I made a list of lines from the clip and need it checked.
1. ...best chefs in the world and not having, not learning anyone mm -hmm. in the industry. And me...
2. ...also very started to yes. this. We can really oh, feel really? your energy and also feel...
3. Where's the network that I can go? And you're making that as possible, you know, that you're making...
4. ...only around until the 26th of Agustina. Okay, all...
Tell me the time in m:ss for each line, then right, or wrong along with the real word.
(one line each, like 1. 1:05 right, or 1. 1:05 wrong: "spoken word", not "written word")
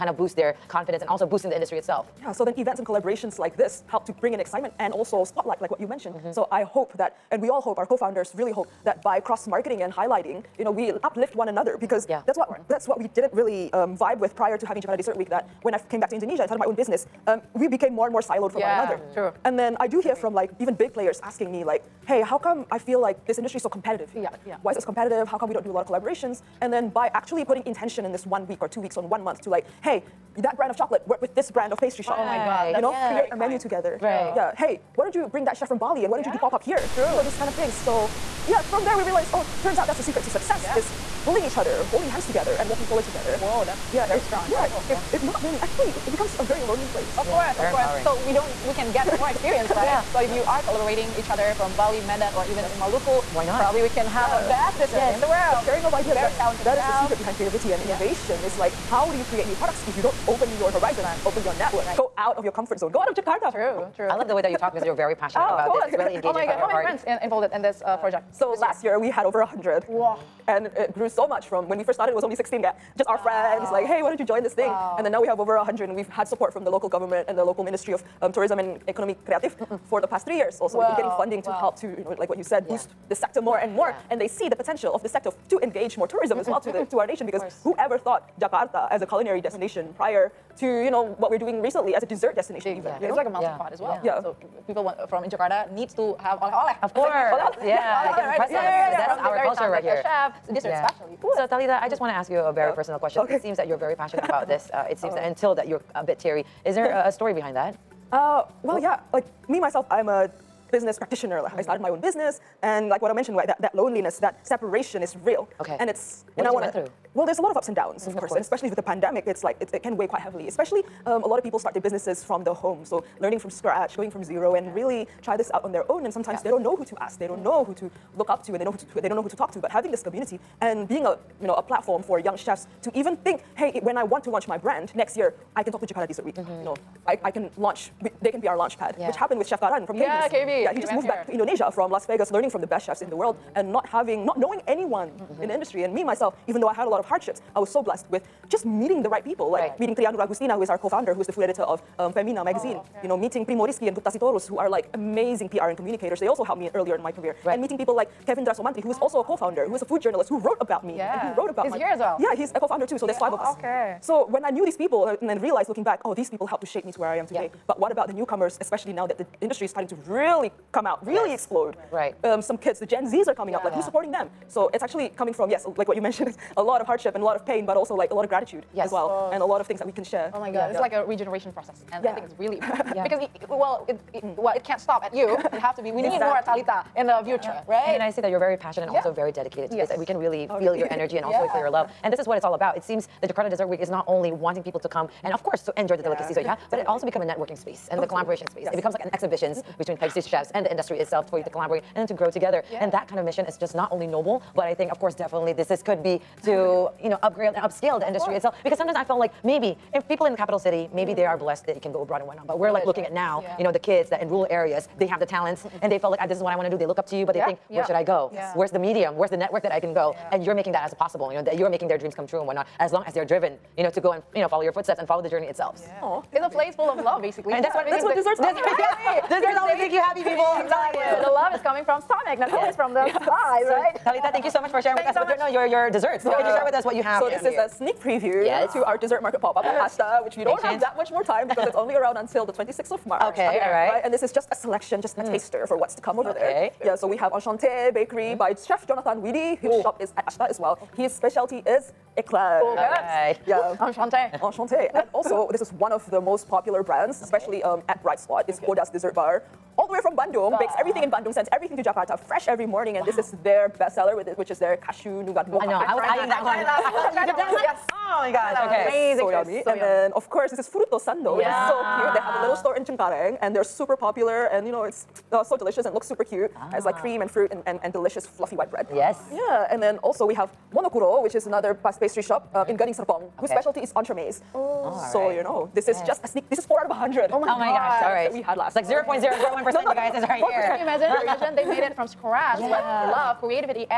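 1. 2:22 wrong: "knowing", not "learning"
2. 3:08 wrong: "dedicated", not "started"
3. 3:39 right
4. 4:01 wrong: "March", not "Agustina".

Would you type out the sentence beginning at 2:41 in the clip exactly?
and who wrote about he's my...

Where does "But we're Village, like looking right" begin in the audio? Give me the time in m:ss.
3:32.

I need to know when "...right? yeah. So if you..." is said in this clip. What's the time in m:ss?
0:49.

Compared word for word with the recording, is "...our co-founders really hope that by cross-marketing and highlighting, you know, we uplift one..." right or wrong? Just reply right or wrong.
right.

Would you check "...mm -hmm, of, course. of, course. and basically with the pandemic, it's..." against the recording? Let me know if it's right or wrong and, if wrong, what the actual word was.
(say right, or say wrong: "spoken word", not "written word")
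wrong: "especially", not "basically".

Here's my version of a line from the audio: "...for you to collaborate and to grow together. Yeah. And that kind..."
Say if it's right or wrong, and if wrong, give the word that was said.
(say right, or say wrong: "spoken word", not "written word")
right.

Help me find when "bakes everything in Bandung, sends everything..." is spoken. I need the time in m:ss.
4:20.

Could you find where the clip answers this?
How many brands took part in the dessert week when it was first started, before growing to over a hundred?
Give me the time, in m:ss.
1:12.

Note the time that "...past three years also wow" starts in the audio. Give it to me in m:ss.
1:20.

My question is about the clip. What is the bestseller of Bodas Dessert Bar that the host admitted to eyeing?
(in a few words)
Cashew nougat mocha.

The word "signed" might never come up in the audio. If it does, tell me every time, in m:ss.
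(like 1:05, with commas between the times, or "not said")
not said.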